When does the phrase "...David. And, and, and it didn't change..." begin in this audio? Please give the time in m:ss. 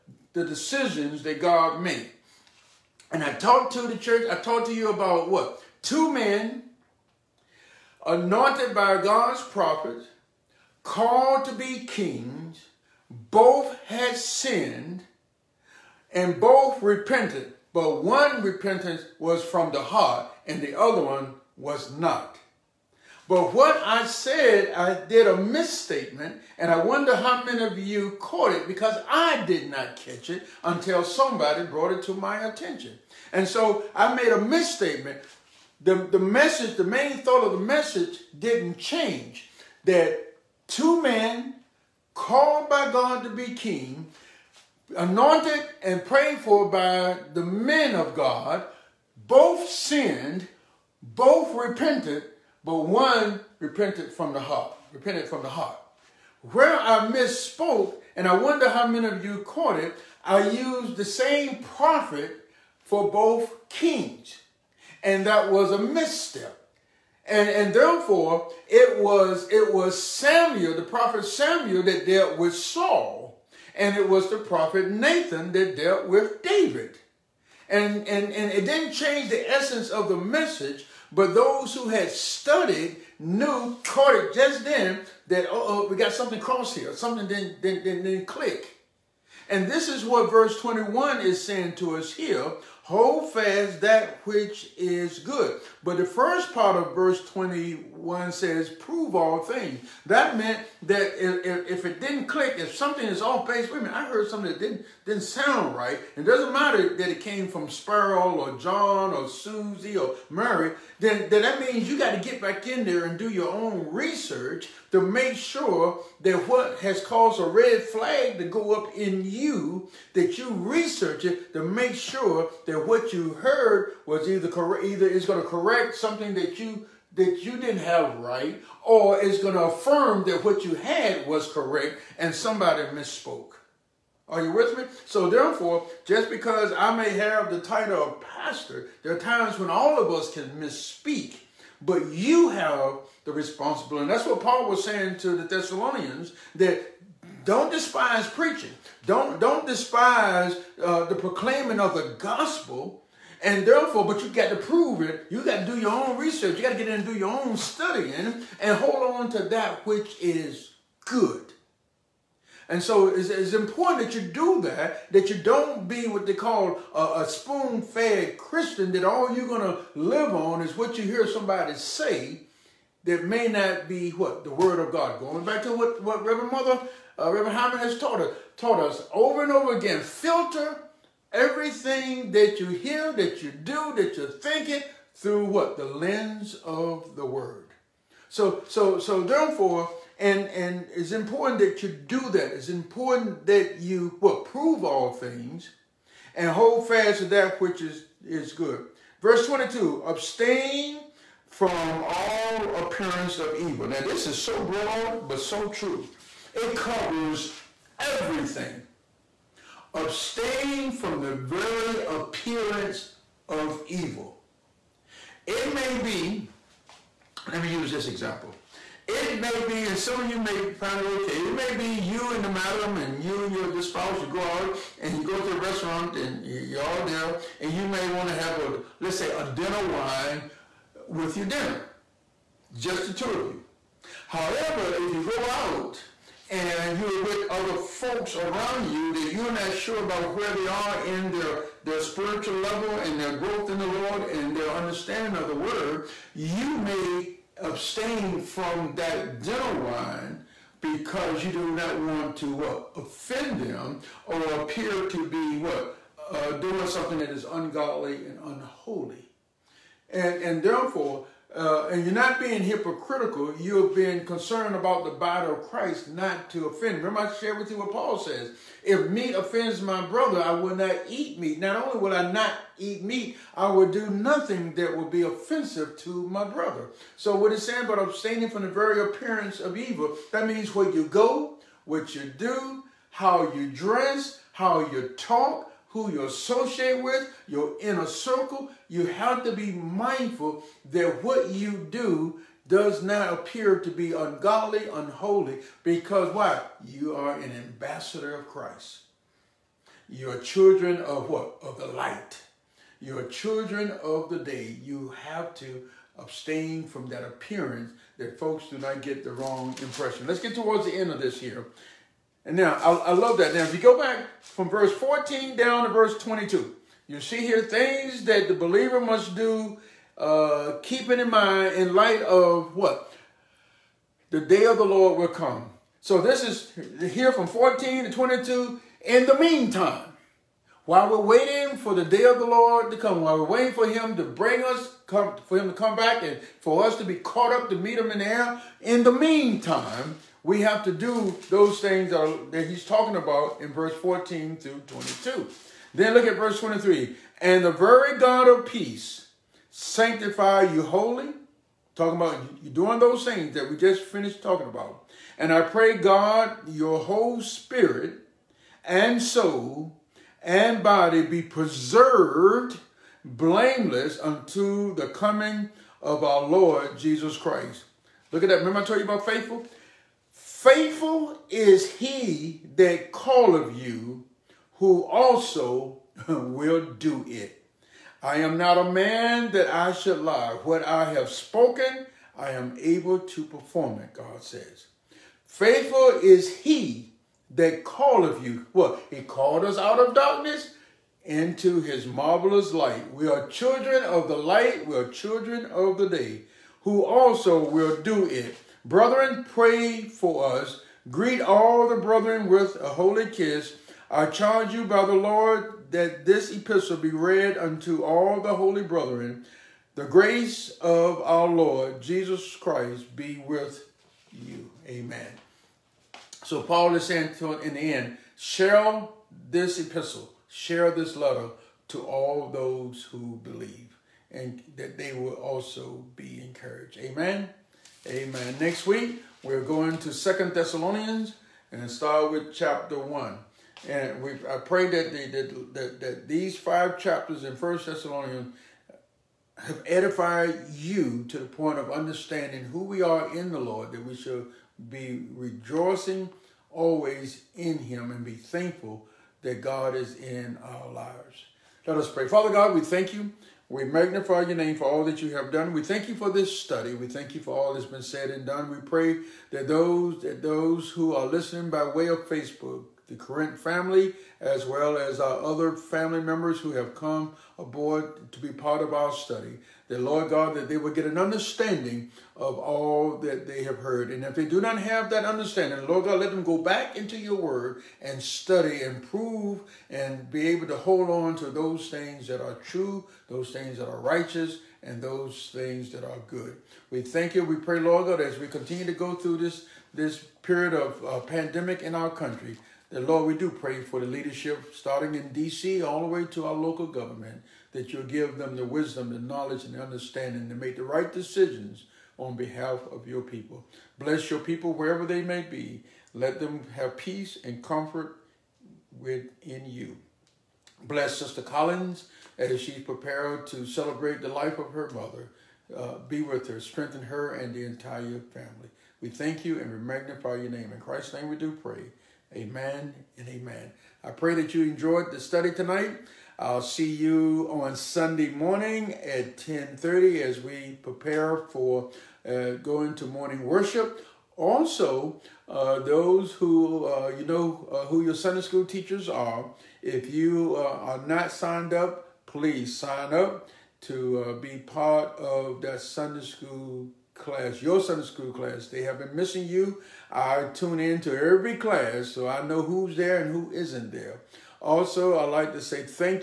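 1:16.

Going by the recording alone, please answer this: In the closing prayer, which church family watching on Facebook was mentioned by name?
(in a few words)
Corinth.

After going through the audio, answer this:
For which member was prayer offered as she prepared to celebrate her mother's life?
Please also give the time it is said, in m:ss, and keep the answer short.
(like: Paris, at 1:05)
Sister Collins, at 8:31.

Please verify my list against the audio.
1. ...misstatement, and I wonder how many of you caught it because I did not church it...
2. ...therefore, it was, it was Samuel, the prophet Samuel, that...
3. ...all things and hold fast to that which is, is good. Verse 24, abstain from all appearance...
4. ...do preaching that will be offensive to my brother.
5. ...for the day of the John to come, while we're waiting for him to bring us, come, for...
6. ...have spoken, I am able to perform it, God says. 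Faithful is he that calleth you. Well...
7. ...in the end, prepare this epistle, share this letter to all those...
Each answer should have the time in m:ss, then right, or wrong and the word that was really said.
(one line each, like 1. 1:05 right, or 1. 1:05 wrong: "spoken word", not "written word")
1. 0:25 wrong: "catch", not "church"
2. 1:07 right
3. 3:14 wrong: "22", not "24"
4. 4:33 wrong: "nothing", not "preaching"
5. 5:31 wrong: "Lord", not "John"
6. 6:21 right
7. 6:57 wrong: "share", not "prepare".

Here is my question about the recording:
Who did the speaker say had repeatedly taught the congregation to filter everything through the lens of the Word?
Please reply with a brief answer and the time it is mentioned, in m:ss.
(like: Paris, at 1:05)
Reverend Hyman, at 2:57.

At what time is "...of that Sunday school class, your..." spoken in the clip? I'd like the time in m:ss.
9:05.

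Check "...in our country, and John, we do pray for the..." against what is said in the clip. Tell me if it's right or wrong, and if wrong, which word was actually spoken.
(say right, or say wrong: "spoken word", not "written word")
wrong: "Lord", not "John".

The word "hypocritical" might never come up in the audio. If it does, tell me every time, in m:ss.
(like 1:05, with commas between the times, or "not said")
4:22.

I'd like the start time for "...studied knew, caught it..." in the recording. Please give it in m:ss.
1:22.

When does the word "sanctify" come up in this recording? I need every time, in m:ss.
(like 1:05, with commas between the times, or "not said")
5:49.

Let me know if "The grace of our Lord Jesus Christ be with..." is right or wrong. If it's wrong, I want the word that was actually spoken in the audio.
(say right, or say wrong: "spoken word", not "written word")
right.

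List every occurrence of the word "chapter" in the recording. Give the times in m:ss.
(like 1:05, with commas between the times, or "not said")
7:12, 7:16.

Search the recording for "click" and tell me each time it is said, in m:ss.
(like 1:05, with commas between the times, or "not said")
1:28, 1:42.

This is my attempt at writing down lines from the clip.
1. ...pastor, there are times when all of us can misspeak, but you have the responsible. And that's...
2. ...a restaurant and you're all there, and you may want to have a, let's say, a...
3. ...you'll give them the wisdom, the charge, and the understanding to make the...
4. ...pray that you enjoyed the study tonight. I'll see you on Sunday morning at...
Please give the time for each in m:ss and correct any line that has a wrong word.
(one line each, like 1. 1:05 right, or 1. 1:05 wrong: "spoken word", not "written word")
1. 2:18 right
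2. 3:45 right
3. 8:17 wrong: "knowledge", not "charge"
4. 8:44 right.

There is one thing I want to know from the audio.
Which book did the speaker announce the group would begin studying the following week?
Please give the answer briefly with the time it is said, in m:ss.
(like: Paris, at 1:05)
Second Thessalonians, at 7:10.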